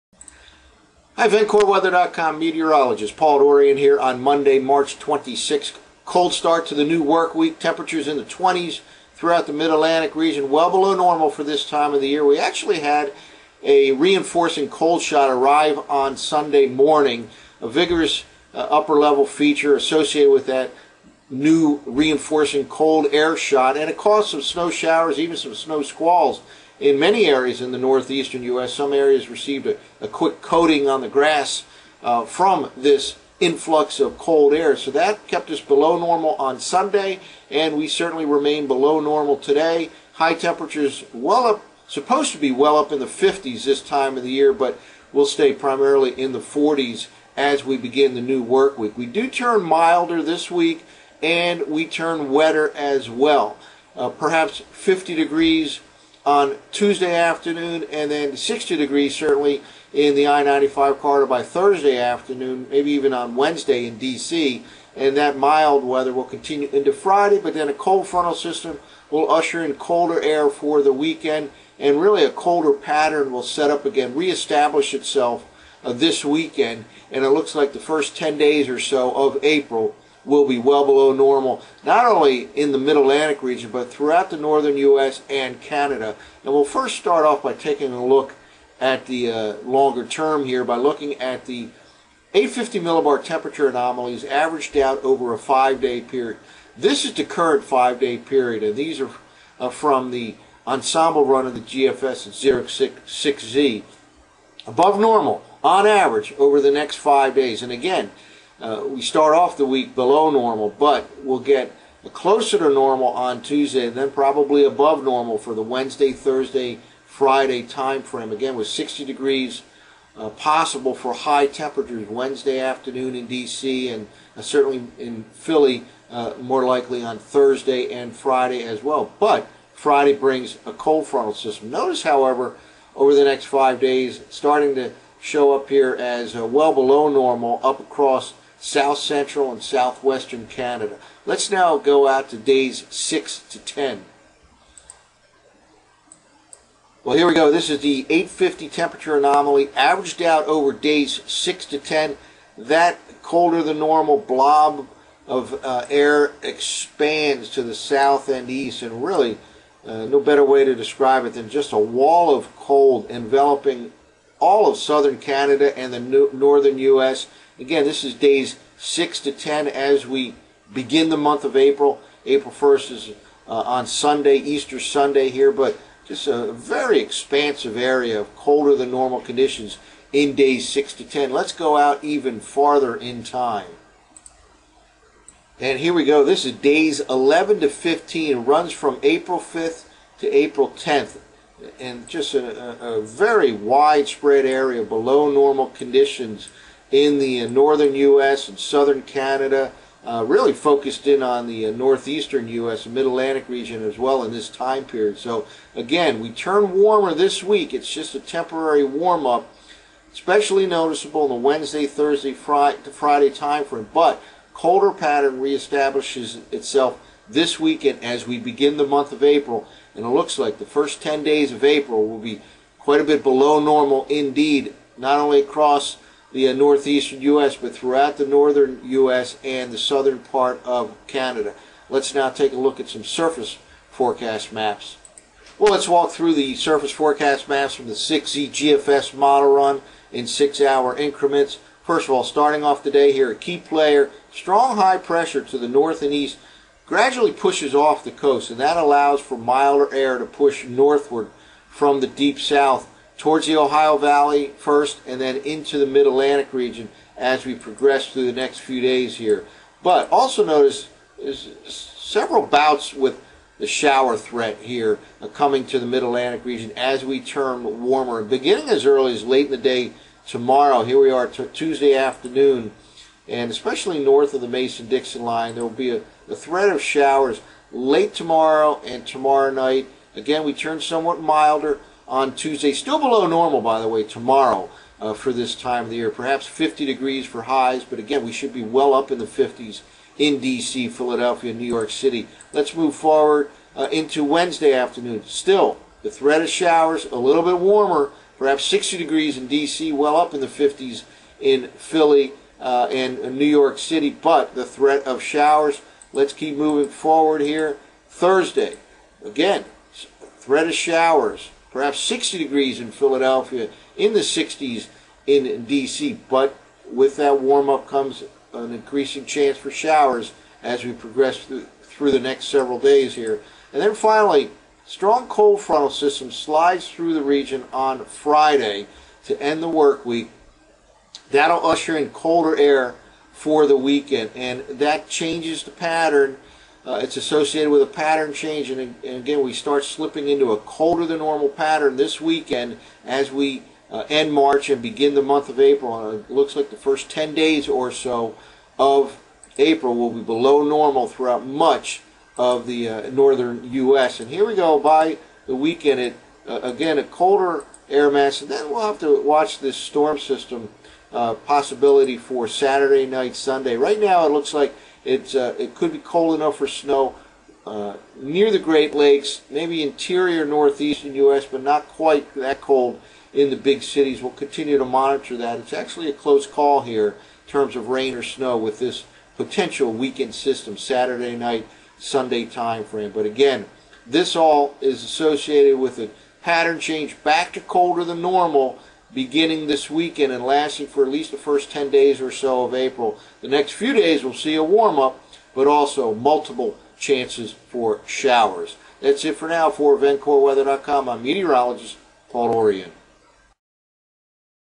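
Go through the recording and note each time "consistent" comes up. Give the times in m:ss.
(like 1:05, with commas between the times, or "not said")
not said.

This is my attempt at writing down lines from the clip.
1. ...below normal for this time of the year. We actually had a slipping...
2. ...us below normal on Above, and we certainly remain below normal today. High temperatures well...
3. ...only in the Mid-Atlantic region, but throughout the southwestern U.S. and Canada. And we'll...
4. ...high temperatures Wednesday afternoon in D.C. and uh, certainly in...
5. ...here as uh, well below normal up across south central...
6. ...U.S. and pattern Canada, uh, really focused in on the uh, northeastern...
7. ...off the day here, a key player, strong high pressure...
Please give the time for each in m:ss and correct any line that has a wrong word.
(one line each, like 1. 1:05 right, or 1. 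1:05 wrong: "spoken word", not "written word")
1. 0:10 wrong: "reinforcing", not "slipping"
2. 0:35 wrong: "Sunday", not "Above"
3. 1:22 wrong: "northern", not "southwestern"
4. 2:01 right
5. 2:15 right
6. 3:17 wrong: "southern", not "pattern"
7. 4:02 right.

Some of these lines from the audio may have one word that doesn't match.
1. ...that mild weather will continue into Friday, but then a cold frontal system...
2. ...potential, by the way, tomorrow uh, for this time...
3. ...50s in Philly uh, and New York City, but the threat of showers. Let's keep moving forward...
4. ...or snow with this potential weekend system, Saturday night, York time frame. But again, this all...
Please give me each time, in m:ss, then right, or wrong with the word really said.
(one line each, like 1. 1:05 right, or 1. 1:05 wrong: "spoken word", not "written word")
1. 1:05 right
2. 4:43 wrong: "normal", not "potential"
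3. 5:00 right
4. 6:18 wrong: "Sunday", not "York".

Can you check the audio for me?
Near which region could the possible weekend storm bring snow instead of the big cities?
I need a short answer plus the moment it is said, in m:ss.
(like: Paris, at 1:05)
Great Lakes, at 6:08.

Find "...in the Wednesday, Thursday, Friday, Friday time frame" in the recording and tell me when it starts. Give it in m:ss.
3:31.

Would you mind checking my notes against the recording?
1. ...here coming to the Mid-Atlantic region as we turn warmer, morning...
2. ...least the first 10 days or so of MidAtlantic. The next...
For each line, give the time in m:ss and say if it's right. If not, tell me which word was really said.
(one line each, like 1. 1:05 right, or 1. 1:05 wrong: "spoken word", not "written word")
1. 4:24 wrong: "beginning", not "morning"
2. 6:31 wrong: "April", not "MidAtlantic".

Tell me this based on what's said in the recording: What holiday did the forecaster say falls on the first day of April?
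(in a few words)
Easter Sunday.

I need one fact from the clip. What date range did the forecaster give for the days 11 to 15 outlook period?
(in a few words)
April 5th to April 10th.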